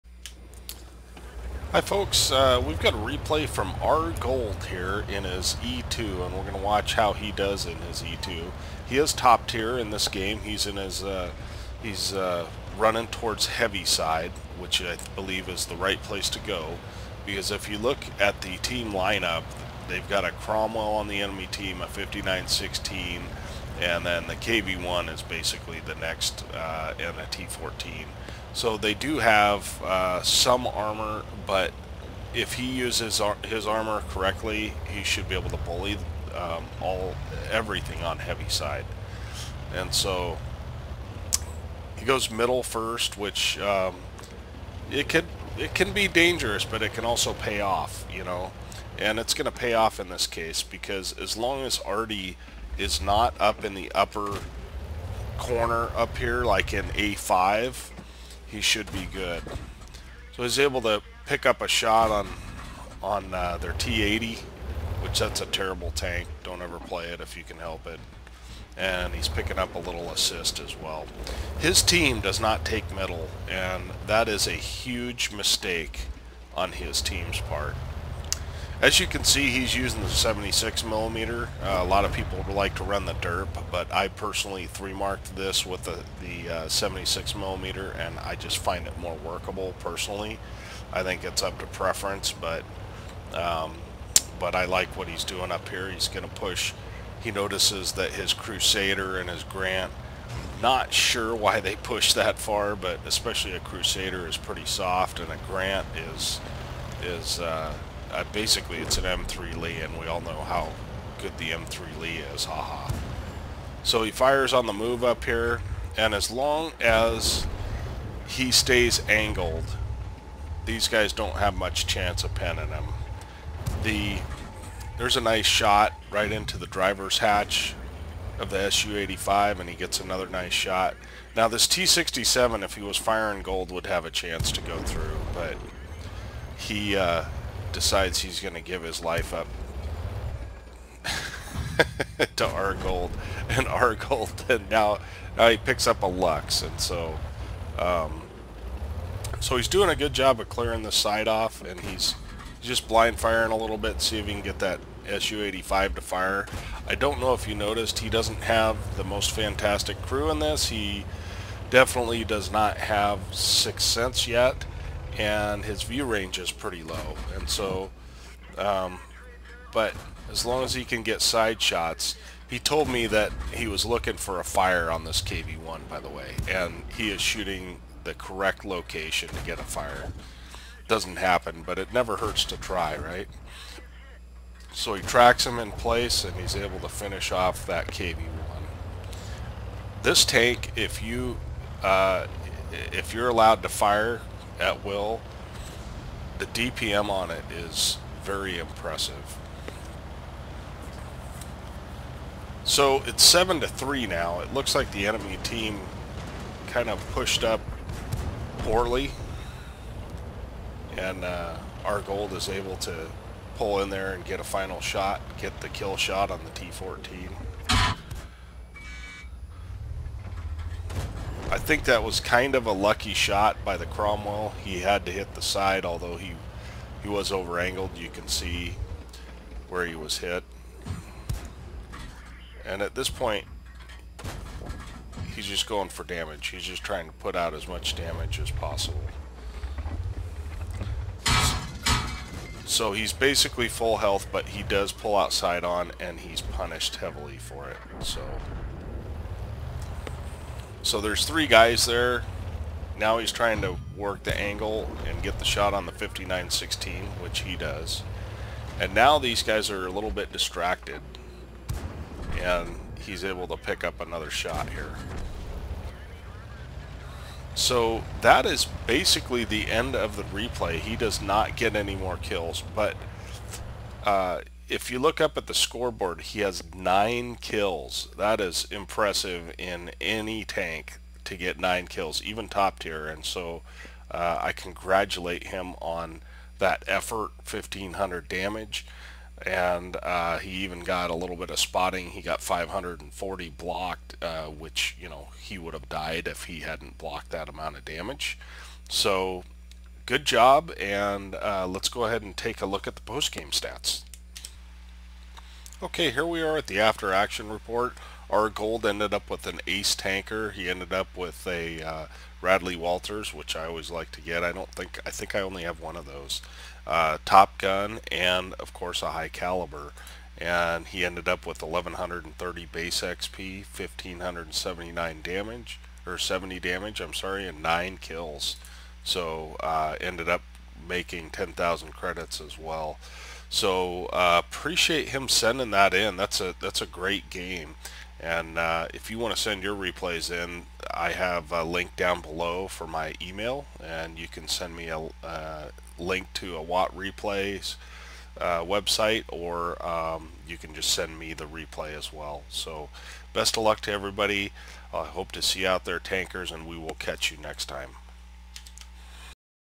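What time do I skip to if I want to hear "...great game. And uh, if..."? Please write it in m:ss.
5:36.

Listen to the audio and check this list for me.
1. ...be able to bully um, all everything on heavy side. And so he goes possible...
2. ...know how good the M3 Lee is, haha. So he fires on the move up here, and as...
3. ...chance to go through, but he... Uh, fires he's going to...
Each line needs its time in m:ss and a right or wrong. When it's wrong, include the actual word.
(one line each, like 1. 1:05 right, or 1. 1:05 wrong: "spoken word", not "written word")
1. 0:35 wrong: "middle", not "possible"
2. 1:50 right
3. 2:14 wrong: "decides", not "fires".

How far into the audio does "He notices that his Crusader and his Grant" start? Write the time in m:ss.
1:37.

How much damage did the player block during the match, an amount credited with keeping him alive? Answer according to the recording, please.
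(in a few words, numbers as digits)
540.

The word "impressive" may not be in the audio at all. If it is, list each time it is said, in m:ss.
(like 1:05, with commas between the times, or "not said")
3:18, 4:38.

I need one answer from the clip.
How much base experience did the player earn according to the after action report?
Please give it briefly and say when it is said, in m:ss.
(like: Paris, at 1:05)
1130, at 5:21.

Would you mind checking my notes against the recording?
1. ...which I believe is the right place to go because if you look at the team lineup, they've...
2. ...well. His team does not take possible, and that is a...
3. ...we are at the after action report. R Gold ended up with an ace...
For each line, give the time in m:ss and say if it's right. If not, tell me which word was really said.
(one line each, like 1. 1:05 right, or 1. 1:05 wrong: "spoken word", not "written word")
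1. 0:14 right
2. 1:10 wrong: "middle", not "possible"
3. 5:06 right.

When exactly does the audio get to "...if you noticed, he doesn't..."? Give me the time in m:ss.
2:37.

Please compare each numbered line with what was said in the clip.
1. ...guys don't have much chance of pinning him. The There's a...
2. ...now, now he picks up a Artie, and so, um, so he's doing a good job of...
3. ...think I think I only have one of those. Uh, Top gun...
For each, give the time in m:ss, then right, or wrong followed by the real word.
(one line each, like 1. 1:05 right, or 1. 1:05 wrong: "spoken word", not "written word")
1. 2:00 right
2. 2:24 wrong: "Luchs", not "Artie"
3. 5:14 right.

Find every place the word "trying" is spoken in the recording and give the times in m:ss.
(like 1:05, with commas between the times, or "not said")
3:56, 4:13.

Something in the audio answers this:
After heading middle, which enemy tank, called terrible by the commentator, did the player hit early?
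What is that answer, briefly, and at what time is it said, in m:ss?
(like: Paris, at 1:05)
T80, at 1:03.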